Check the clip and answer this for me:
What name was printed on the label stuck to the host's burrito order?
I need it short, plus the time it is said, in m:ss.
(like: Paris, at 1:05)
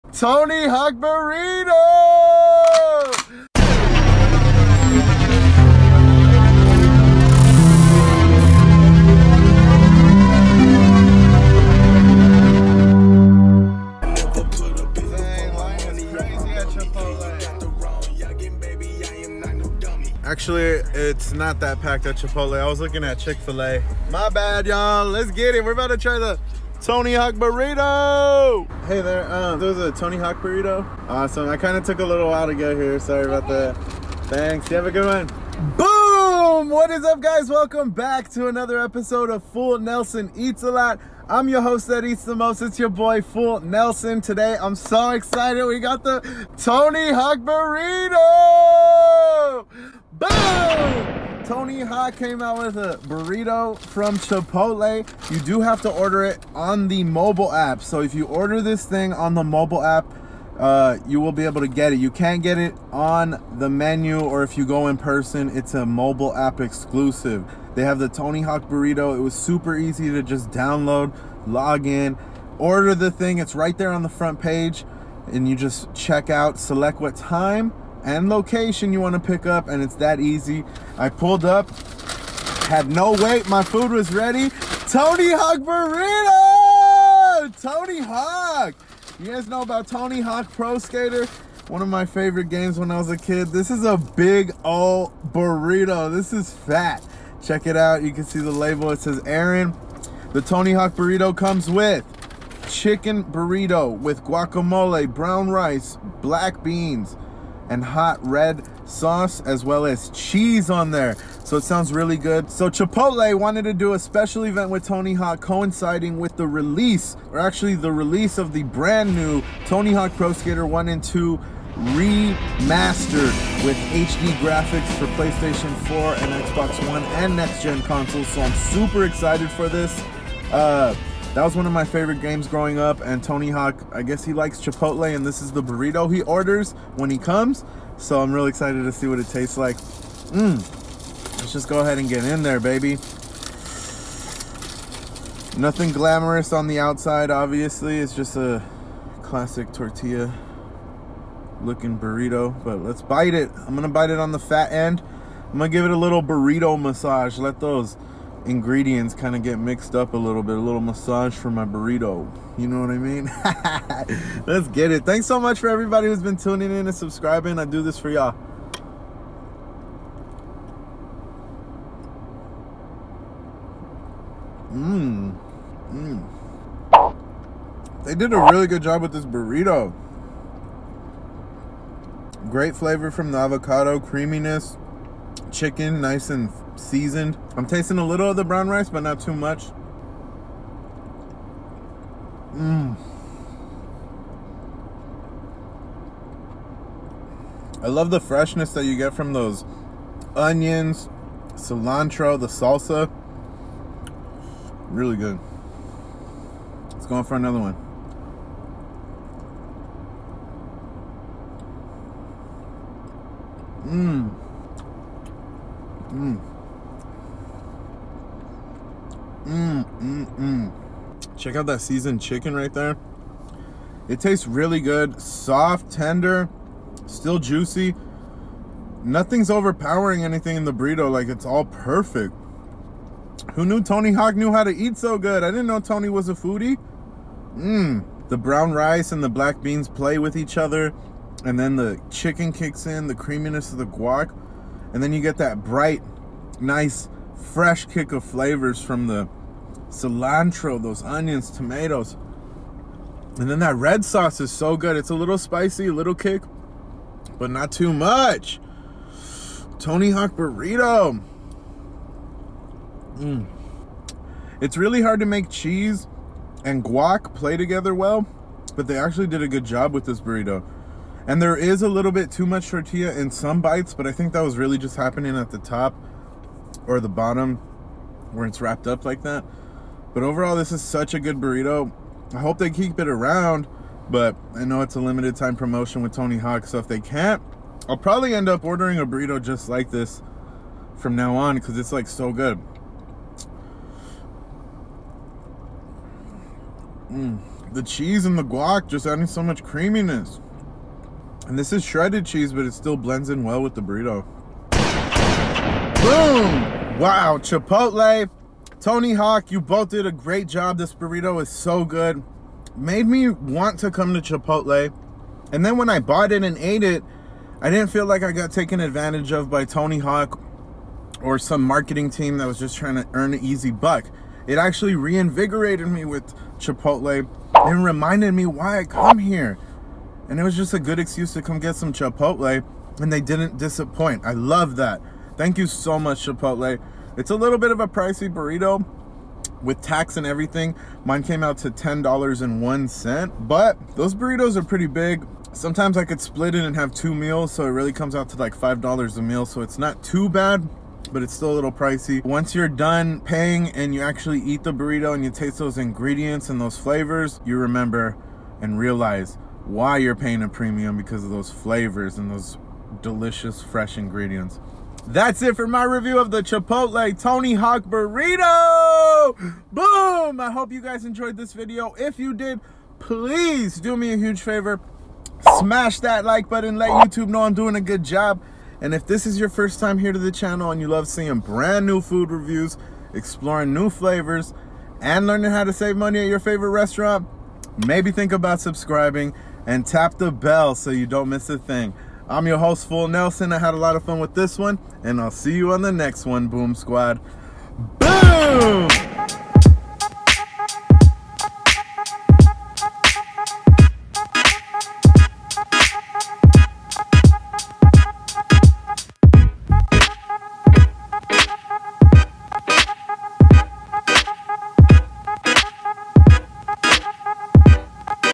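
Aaron, at 1:39.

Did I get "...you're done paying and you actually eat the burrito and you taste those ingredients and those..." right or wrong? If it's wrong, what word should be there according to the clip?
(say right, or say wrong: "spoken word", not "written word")
right.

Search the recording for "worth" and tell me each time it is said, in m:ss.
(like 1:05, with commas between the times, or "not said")
not said.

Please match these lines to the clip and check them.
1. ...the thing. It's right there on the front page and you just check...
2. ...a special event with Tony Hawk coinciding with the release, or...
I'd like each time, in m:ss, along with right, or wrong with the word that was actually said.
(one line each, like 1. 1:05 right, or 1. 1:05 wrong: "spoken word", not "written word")
1. 1:12 right
2. 1:53 right.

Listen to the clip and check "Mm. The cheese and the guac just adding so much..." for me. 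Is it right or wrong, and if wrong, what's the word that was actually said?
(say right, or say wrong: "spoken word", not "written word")
right.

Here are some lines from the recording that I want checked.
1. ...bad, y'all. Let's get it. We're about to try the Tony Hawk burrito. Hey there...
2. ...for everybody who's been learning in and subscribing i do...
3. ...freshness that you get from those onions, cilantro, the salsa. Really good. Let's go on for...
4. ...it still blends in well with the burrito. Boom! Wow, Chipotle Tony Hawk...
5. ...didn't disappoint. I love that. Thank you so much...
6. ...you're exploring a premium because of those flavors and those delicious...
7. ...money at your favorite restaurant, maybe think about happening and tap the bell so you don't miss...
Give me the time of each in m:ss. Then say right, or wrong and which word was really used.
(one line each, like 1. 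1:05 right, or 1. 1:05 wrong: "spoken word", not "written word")
1. 0:24 right
2. 2:45 wrong: "tuning", not "learning"
3. 3:18 right
4. 5:02 right
5. 5:33 right
6. 5:59 wrong: "paying", not "exploring"
7. 6:25 wrong: "subscribing", not "happening".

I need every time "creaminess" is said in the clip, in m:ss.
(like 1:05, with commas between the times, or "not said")
3:03, 4:03, 4:59.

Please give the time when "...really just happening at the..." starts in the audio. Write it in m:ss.
4:34.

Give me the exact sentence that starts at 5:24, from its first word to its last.
It actually reinvigorated me with Chipotle and reminded me why I come here.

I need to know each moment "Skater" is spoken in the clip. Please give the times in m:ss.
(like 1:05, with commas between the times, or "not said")
1:30, 2:00.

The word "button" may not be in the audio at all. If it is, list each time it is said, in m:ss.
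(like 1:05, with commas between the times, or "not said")
6:16.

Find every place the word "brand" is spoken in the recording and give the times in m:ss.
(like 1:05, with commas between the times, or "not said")
1:58, 6:21.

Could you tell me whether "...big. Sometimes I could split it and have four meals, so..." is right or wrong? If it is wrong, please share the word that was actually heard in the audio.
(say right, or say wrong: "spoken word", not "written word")
wrong: "two", not "four".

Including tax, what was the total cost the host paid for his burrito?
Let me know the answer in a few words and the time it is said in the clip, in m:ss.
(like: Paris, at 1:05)
$10.01, at 5:41.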